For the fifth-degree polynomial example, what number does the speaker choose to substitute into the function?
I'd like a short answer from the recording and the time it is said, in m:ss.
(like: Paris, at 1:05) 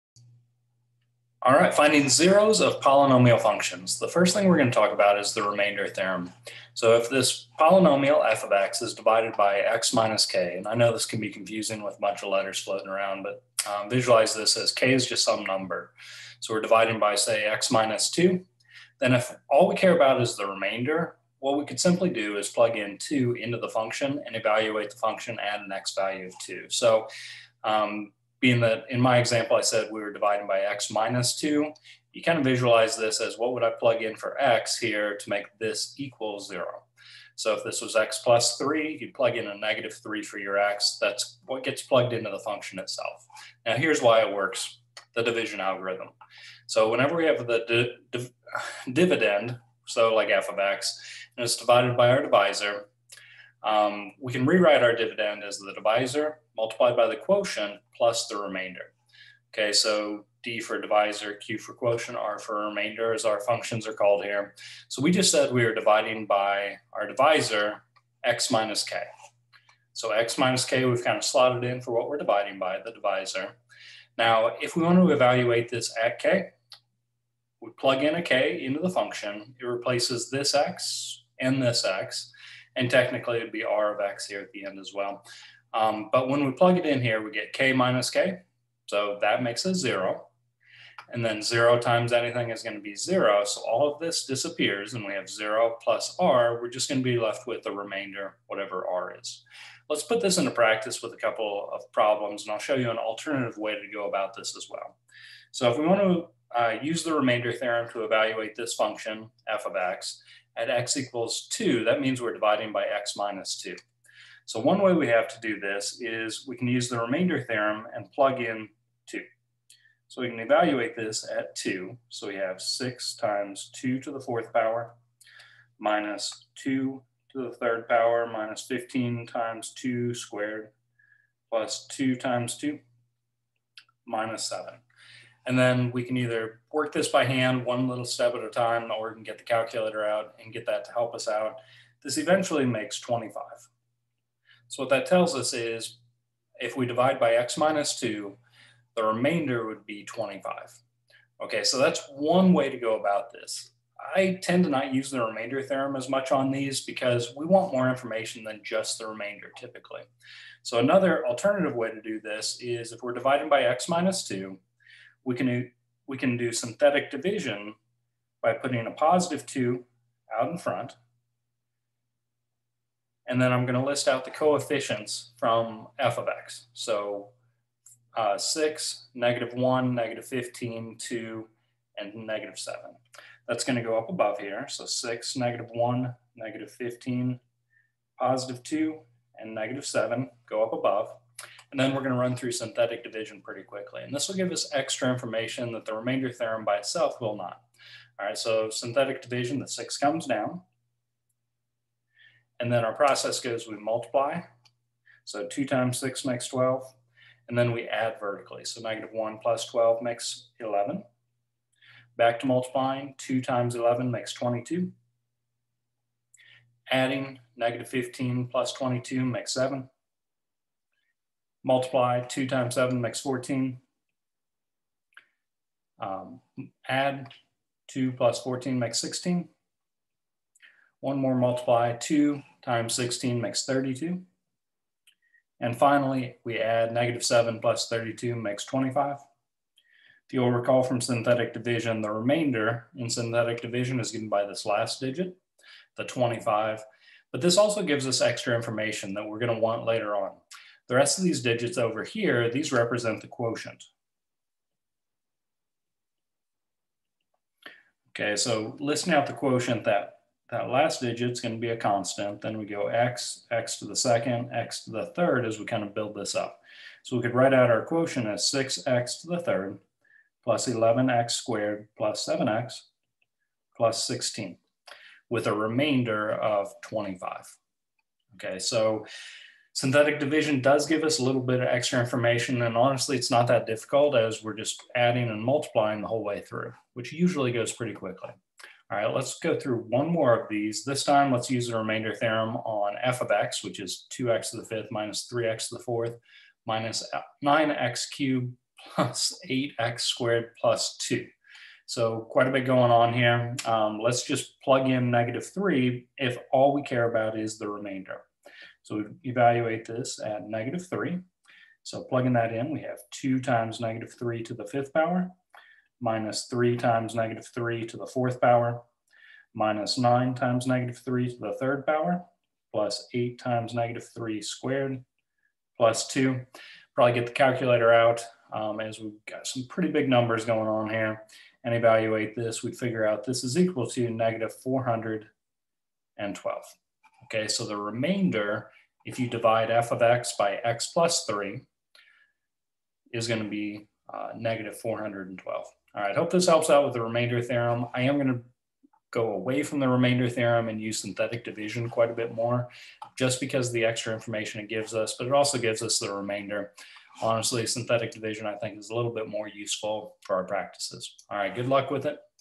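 negative 3, at 5:04.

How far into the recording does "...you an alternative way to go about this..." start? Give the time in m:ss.
1:42.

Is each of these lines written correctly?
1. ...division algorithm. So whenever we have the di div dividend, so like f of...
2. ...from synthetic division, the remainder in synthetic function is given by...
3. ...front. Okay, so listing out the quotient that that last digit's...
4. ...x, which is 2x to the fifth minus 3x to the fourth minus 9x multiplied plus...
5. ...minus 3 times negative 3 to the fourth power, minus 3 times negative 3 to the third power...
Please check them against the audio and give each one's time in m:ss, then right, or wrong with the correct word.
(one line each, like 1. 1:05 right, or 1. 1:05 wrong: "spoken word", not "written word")
1. 0:45 right
2. 4:00 wrong: "division", not "function"
3. 4:13 wrong: "quotient", not "front"
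4. 4:53 wrong: "cubed", not "multiplied"
5. 5:16 wrong: "9", not "3".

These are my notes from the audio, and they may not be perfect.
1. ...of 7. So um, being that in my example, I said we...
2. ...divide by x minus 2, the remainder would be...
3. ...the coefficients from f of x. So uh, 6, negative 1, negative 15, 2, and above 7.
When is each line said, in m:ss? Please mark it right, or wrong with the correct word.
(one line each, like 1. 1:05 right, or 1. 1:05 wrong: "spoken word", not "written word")
1. 0:26 wrong: "2", not "7"
2. 2:26 right
3. 2:54 wrong: "negative", not "above".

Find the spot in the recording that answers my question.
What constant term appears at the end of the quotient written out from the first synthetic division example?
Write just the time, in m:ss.
4:34.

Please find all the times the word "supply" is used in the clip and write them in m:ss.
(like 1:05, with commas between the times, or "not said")
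not said.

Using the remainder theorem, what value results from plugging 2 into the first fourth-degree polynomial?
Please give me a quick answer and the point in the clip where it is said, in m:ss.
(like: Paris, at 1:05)
25, at 2:22.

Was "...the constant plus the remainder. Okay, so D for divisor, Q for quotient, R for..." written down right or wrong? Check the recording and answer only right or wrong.
wrong.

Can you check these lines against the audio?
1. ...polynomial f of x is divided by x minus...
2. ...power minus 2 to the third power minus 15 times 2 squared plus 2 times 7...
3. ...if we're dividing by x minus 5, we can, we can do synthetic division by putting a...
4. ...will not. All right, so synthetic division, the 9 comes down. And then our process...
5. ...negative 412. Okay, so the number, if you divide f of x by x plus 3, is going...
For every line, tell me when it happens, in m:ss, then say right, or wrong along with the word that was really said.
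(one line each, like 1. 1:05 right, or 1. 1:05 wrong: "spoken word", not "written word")
1. 0:07 right
2. 2:04 wrong: "2", not "7"
3. 2:42 wrong: "2", not "5"
4. 3:17 wrong: "6", not "9"
5. 5:34 wrong: "remainder", not "number".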